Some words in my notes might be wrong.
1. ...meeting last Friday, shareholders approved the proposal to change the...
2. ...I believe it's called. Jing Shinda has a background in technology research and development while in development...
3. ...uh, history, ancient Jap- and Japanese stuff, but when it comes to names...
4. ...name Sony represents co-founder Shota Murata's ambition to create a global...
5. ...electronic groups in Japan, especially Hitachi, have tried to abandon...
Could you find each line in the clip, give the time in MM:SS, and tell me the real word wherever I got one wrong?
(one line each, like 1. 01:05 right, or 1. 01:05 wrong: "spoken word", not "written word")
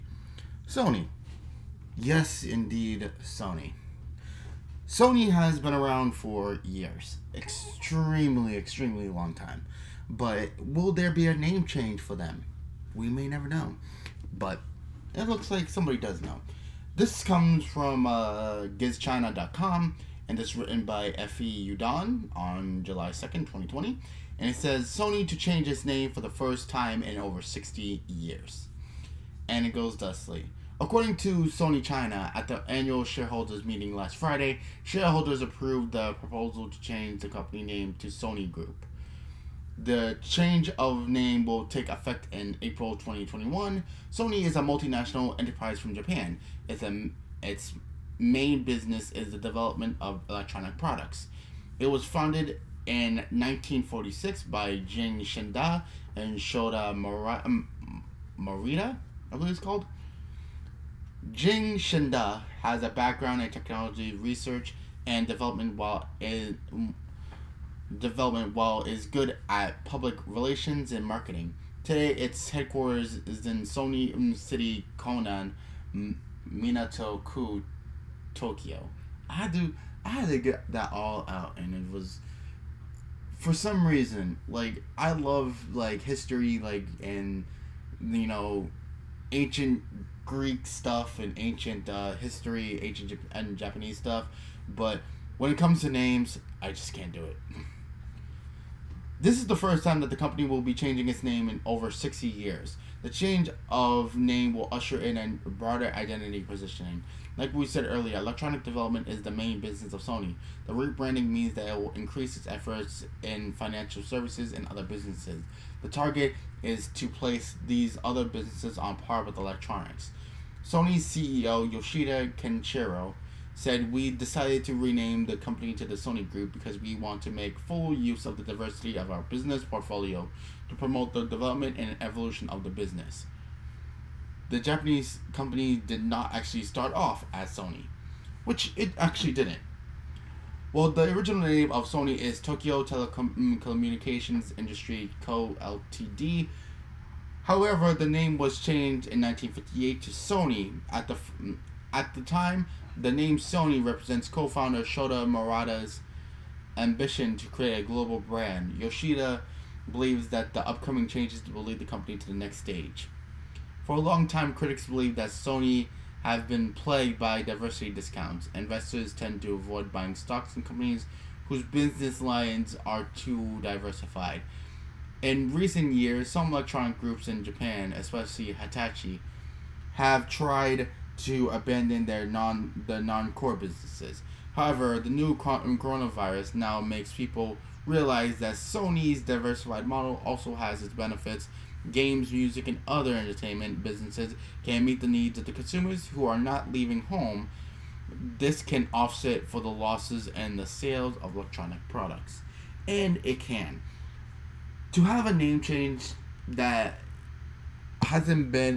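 1. 00:33 right
2. 00:59 right
3. 01:31 right
4. 02:33 right
5. 02:56 right.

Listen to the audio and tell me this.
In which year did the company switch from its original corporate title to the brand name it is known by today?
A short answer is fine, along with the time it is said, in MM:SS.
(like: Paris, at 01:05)
1958, at 02:29.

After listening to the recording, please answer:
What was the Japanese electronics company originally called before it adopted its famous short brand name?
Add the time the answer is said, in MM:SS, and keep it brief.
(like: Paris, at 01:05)
Tokyo Telecommunications Industry Co. Ltd., at 02:22.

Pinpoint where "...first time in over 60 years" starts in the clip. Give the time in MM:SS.
00:26.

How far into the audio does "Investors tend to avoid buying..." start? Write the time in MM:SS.
02:48.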